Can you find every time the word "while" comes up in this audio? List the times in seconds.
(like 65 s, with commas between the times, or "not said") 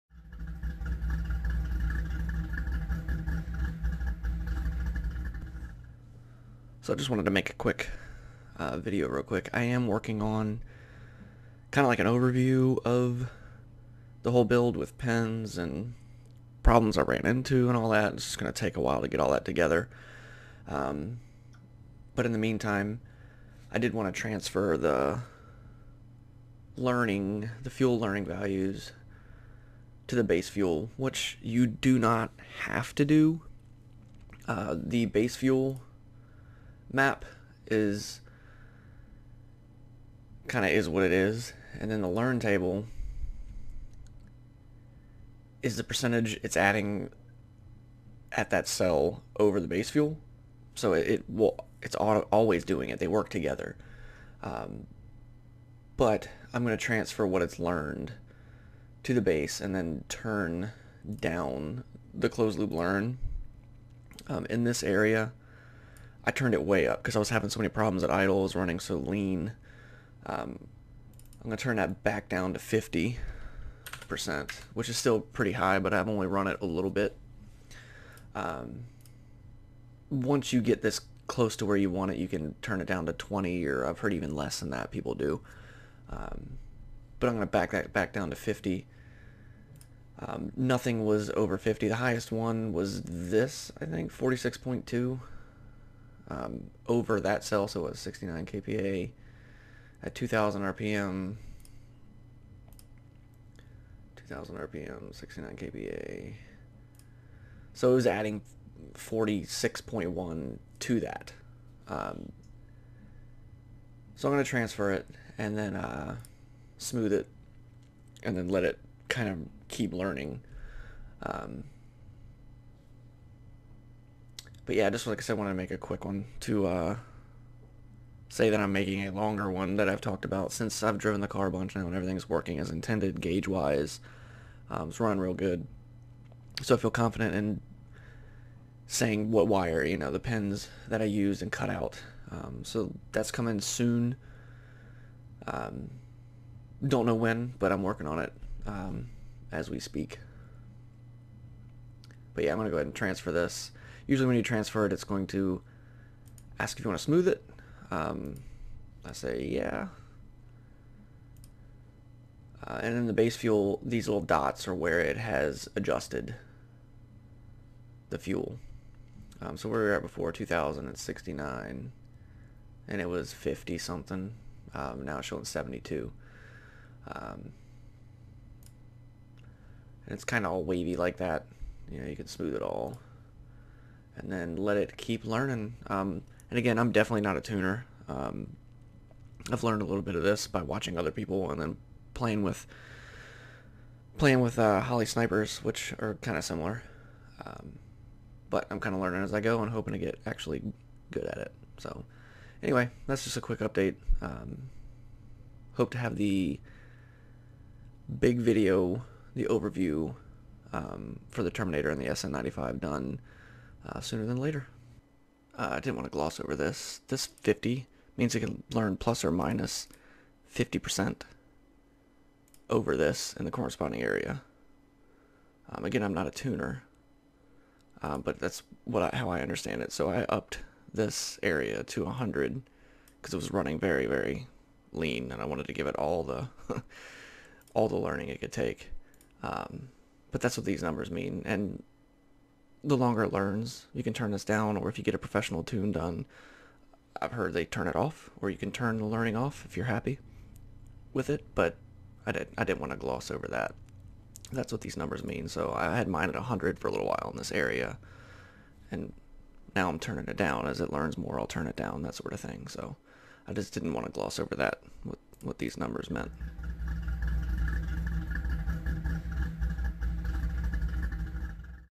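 18 s, 257 s.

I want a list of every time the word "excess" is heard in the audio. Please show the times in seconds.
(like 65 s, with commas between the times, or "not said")
not said.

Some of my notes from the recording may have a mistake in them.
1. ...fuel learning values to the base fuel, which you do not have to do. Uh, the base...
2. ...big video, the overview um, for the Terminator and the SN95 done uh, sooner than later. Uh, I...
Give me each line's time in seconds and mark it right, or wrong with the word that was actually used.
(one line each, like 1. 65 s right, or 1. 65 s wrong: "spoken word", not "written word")
1. 27 s right
2. 208 s right.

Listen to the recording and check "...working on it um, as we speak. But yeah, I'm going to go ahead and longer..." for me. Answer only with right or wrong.
wrong.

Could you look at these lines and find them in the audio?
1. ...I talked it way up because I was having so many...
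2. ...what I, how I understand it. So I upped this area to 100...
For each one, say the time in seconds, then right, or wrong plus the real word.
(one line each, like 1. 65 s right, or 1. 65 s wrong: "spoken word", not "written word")
1. 66 s wrong: "turned", not "talked"
2. 228 s right.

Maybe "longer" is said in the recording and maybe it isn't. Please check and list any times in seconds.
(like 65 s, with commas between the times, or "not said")
129 s, 242 s.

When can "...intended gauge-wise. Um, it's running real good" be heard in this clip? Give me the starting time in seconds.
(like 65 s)
132 s.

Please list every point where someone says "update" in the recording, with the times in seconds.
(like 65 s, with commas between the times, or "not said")
203 s.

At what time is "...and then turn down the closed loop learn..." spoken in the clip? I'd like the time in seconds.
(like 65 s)
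59 s.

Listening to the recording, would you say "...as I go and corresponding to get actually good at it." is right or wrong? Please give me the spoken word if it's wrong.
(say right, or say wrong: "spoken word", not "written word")
wrong: "hoping", not "corresponding".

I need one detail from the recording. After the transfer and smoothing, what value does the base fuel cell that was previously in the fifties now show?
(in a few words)
72.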